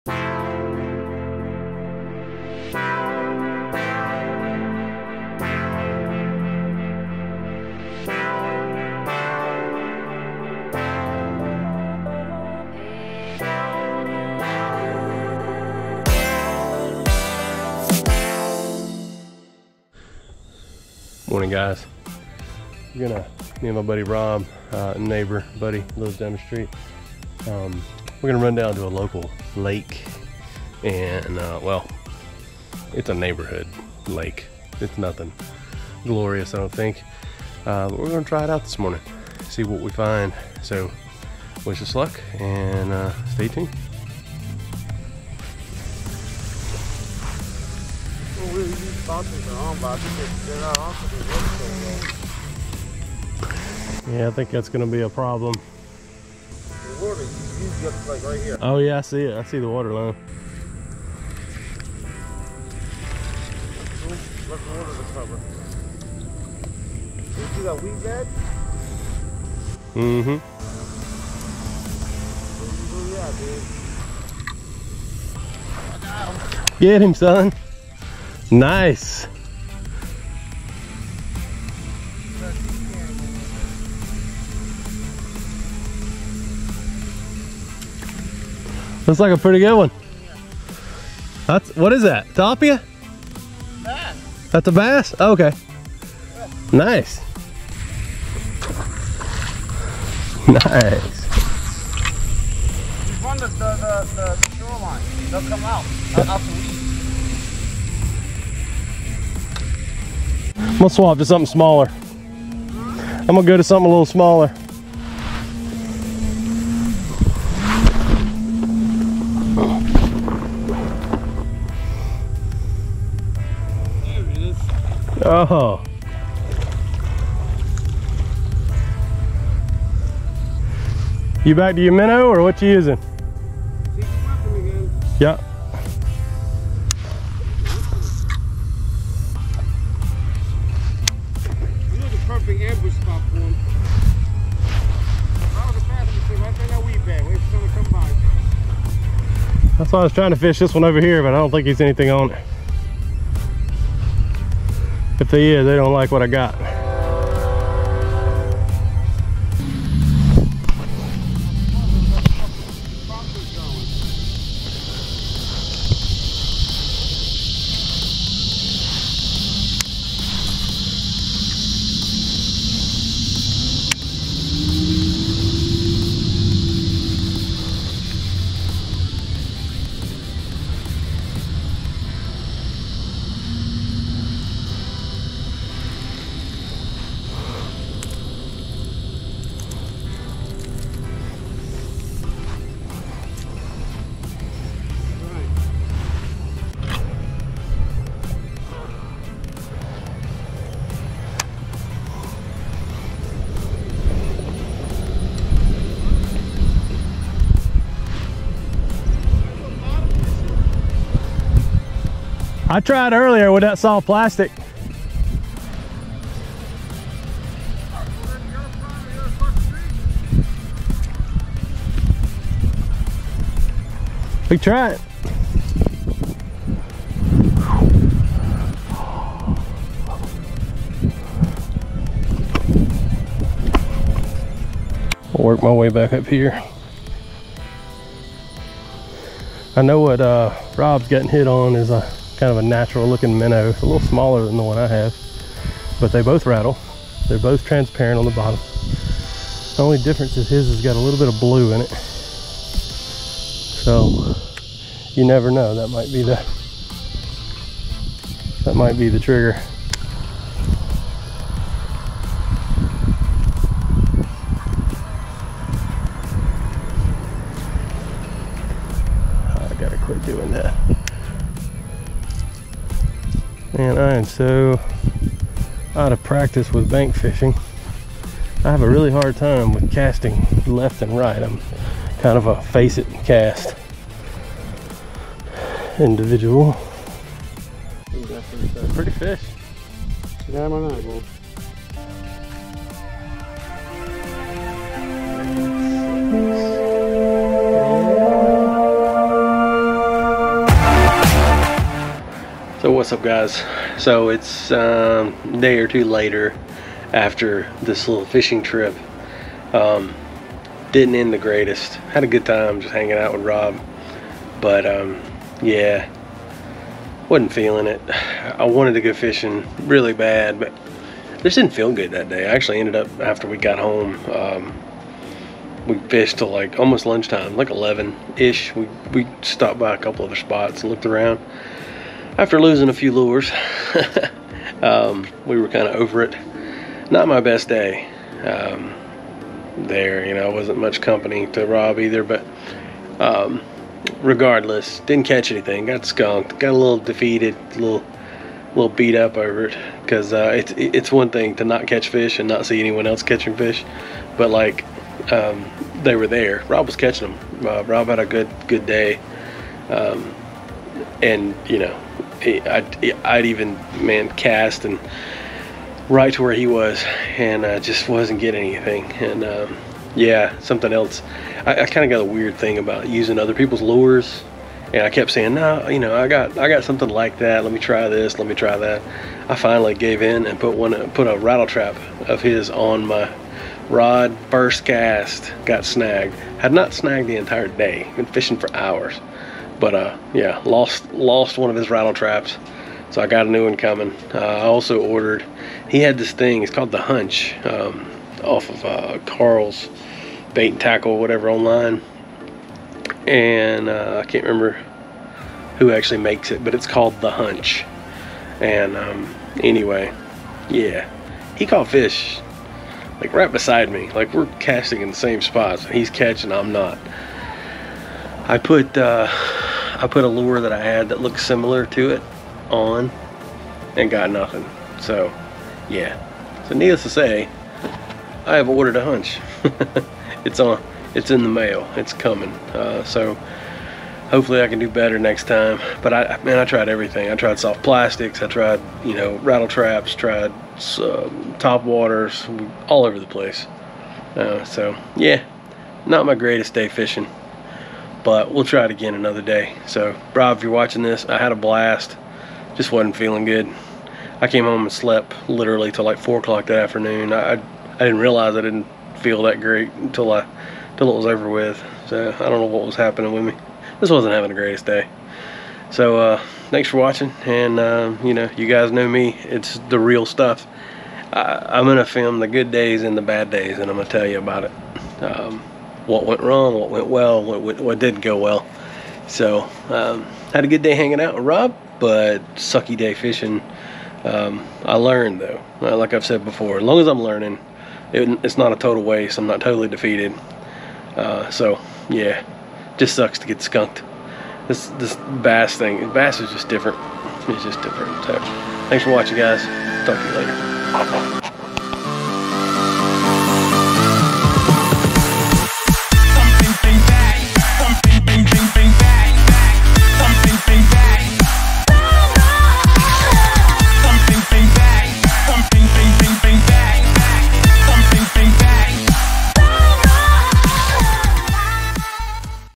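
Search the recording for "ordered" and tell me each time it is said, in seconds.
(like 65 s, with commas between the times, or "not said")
395 s, 428 s.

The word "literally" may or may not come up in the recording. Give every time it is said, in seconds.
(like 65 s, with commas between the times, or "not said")
455 s.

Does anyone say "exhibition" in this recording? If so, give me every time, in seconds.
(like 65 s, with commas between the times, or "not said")
not said.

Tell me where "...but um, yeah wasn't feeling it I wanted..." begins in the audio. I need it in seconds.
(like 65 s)
314 s.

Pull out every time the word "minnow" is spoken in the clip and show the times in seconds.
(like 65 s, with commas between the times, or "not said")
131 s, 243 s.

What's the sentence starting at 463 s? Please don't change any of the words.
This wasn't having the greatest day.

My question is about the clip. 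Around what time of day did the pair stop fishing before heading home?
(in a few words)
11.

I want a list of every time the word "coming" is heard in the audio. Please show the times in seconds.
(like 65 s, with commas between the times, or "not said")
393 s, 432 s.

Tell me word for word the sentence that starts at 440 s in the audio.
Tried uh, top waters, all over the place.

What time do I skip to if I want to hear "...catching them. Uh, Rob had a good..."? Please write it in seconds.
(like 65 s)
356 s.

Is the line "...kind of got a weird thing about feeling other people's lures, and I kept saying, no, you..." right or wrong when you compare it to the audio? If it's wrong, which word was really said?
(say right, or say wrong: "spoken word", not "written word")
wrong: "using", not "feeling".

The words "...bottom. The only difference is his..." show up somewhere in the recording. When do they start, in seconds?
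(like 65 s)
248 s.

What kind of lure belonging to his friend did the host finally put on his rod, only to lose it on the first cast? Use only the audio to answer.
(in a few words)
rattle trap.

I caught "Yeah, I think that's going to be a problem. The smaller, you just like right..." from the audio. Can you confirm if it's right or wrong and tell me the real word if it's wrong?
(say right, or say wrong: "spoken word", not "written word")
wrong: "water", not "smaller".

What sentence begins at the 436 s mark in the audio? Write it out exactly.
But I, man, I tried everything.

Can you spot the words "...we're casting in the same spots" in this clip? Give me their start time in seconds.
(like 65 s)
414 s.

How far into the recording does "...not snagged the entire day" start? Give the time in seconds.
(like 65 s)
386 s.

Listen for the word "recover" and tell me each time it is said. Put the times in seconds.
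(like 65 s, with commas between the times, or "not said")
64 s.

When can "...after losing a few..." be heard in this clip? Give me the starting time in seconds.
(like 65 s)
332 s.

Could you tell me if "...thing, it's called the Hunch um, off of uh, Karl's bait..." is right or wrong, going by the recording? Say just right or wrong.
right.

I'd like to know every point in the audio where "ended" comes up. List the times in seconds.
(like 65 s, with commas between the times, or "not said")
322 s.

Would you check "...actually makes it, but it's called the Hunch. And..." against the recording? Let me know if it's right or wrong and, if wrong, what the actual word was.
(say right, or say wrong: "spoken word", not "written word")
right.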